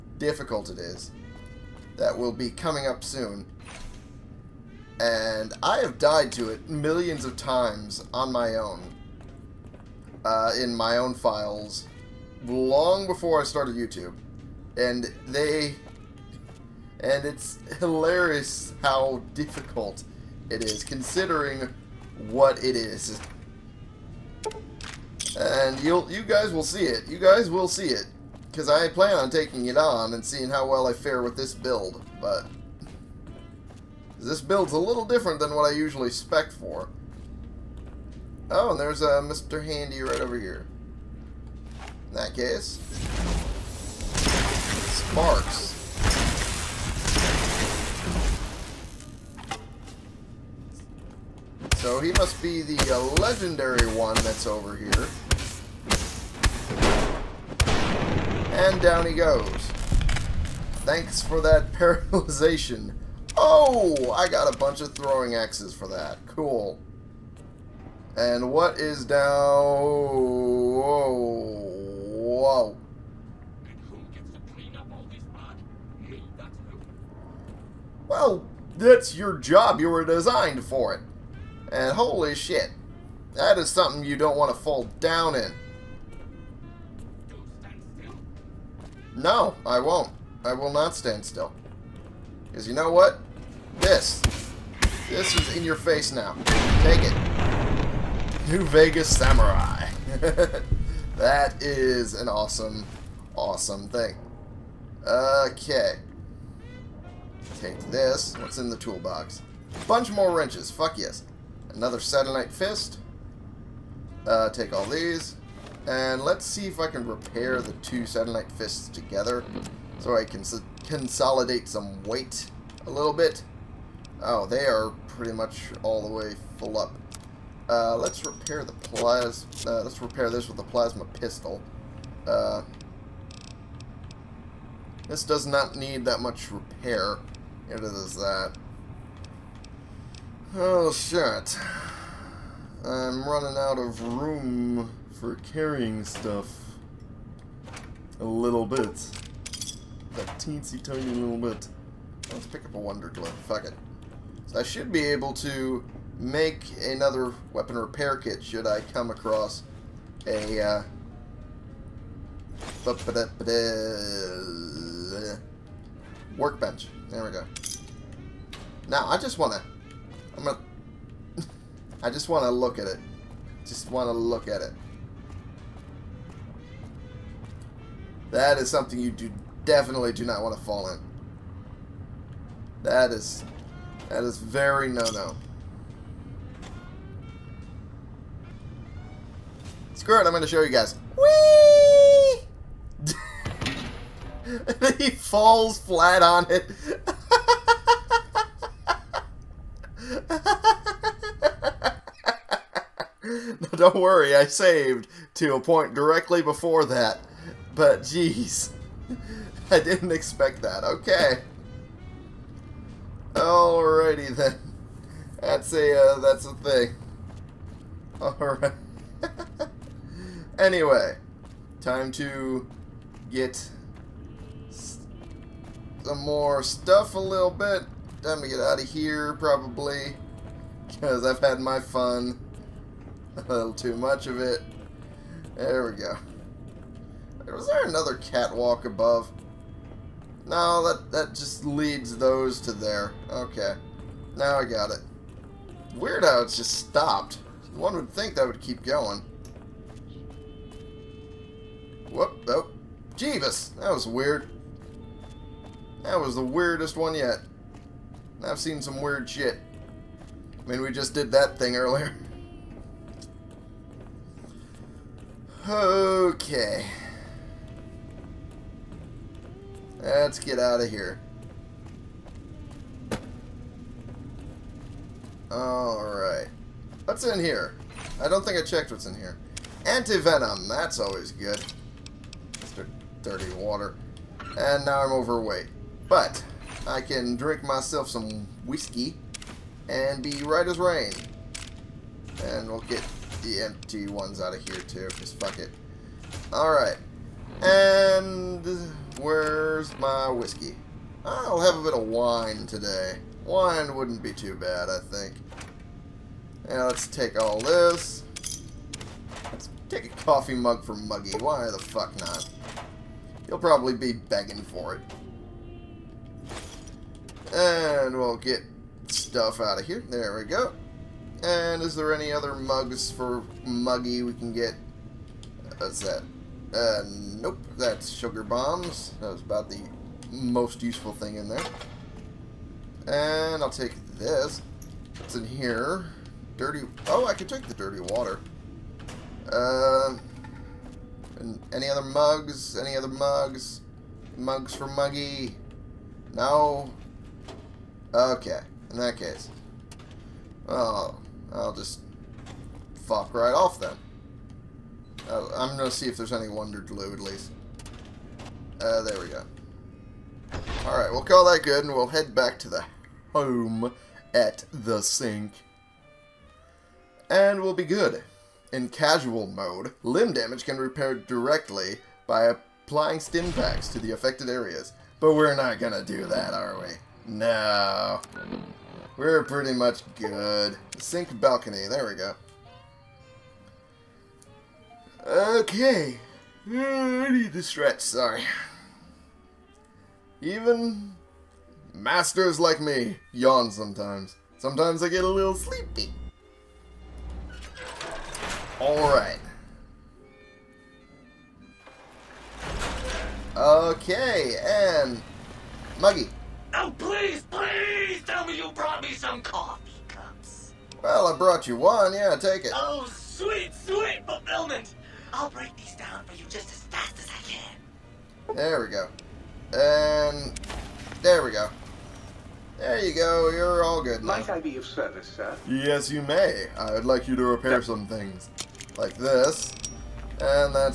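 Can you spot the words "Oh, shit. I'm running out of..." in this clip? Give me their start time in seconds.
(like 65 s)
140 s.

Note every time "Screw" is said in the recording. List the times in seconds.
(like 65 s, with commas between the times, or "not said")
189 s.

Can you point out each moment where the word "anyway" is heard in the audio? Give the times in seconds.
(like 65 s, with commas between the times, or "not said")
220 s.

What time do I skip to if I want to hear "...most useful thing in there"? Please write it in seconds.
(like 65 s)
330 s.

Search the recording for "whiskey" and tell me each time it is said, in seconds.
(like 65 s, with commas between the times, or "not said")
288 s, 300 s.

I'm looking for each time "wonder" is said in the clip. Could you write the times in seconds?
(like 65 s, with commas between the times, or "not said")
152 s, 356 s.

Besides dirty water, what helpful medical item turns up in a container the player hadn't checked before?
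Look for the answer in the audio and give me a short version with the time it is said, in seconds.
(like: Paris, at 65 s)
Antivenom, at 279 s.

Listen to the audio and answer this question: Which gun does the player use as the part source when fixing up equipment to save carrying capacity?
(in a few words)
plasma pistol.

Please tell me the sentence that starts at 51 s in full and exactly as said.
So he must be the uh, legendary one that's over here.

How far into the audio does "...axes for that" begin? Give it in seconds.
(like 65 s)
65 s.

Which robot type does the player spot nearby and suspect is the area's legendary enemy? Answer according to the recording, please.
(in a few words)
Mr. Handy.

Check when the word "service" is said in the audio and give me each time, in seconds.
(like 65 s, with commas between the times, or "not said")
424 s.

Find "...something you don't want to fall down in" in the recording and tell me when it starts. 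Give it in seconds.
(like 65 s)
83 s.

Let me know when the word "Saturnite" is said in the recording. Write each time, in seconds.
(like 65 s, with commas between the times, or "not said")
111 s, 118 s.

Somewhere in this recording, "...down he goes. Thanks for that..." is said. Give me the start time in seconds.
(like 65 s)
58 s.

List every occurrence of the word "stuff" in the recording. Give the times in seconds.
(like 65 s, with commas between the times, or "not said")
146 s, 226 s, 319 s.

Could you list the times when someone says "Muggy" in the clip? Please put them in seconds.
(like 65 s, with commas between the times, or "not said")
310 s, 323 s, 344 s, 405 s.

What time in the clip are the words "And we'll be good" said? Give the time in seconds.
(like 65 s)
367 s.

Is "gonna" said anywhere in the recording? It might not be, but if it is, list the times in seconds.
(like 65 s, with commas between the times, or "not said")
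355 s, 375 s.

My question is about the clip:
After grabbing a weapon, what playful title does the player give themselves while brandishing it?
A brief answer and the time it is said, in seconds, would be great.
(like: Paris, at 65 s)
New Vegas Samurai, at 98 s.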